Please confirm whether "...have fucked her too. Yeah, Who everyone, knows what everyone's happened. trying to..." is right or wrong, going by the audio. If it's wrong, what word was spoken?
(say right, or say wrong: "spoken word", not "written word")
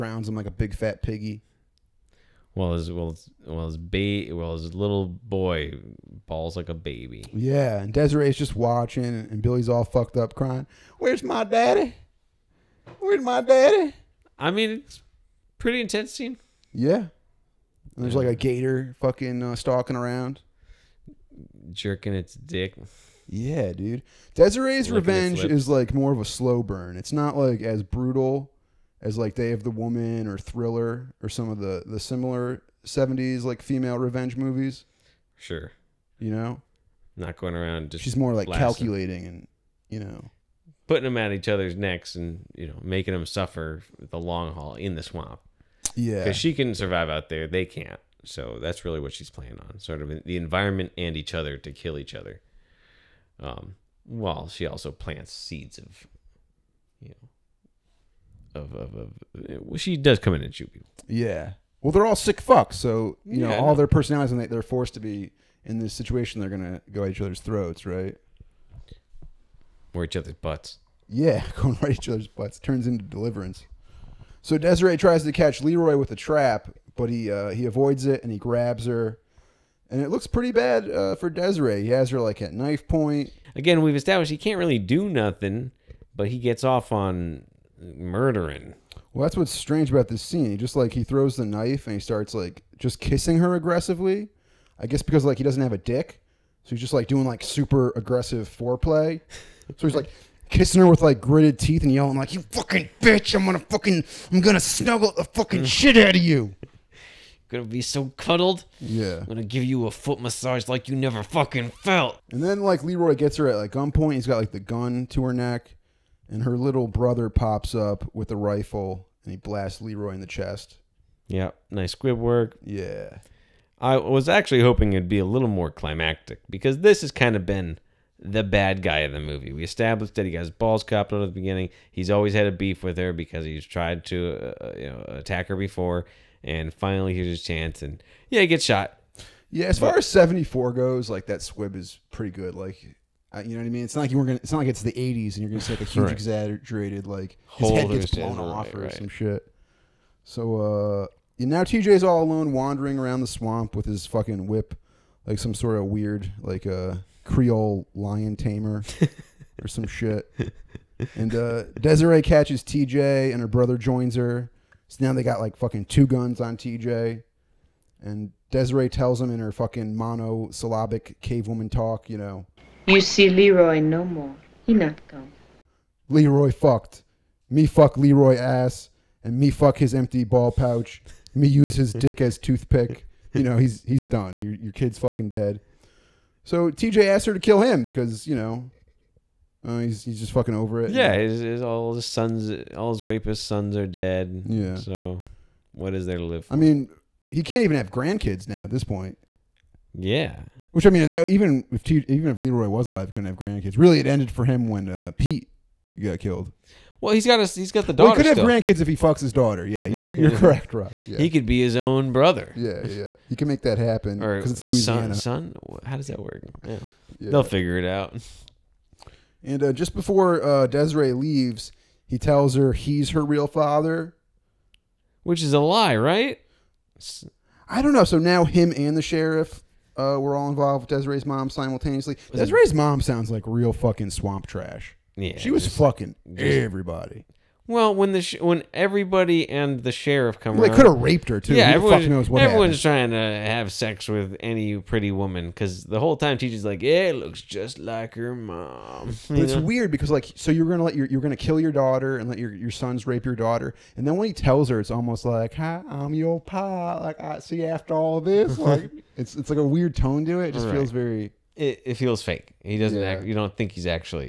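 wrong: "raped", not "fucked".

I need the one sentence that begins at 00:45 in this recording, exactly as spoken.
Yeah, because she can survive out there, they can't.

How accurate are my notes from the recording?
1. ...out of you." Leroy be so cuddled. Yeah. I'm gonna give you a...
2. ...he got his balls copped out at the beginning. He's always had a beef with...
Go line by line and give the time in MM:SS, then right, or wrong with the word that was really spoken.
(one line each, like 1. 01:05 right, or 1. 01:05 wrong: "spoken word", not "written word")
1. 01:45 wrong: "Gonna", not "Leroy"
2. 02:10 right.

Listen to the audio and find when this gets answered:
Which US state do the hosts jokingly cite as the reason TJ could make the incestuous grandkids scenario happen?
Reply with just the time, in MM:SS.
03:34.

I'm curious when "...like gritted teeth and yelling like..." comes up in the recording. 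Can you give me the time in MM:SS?
01:41.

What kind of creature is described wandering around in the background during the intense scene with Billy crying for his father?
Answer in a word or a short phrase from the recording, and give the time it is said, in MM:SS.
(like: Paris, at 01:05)
gator, at 00:18.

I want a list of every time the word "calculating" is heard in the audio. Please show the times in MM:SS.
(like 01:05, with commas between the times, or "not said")
00:38.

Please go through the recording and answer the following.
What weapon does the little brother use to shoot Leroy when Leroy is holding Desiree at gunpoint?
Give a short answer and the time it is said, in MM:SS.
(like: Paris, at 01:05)
rifle, at 01:58.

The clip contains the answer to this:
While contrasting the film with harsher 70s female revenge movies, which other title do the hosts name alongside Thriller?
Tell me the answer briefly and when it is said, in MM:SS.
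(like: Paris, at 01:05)
Day of the Woman, at 00:29.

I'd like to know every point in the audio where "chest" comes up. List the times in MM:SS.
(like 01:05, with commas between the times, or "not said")
02:00.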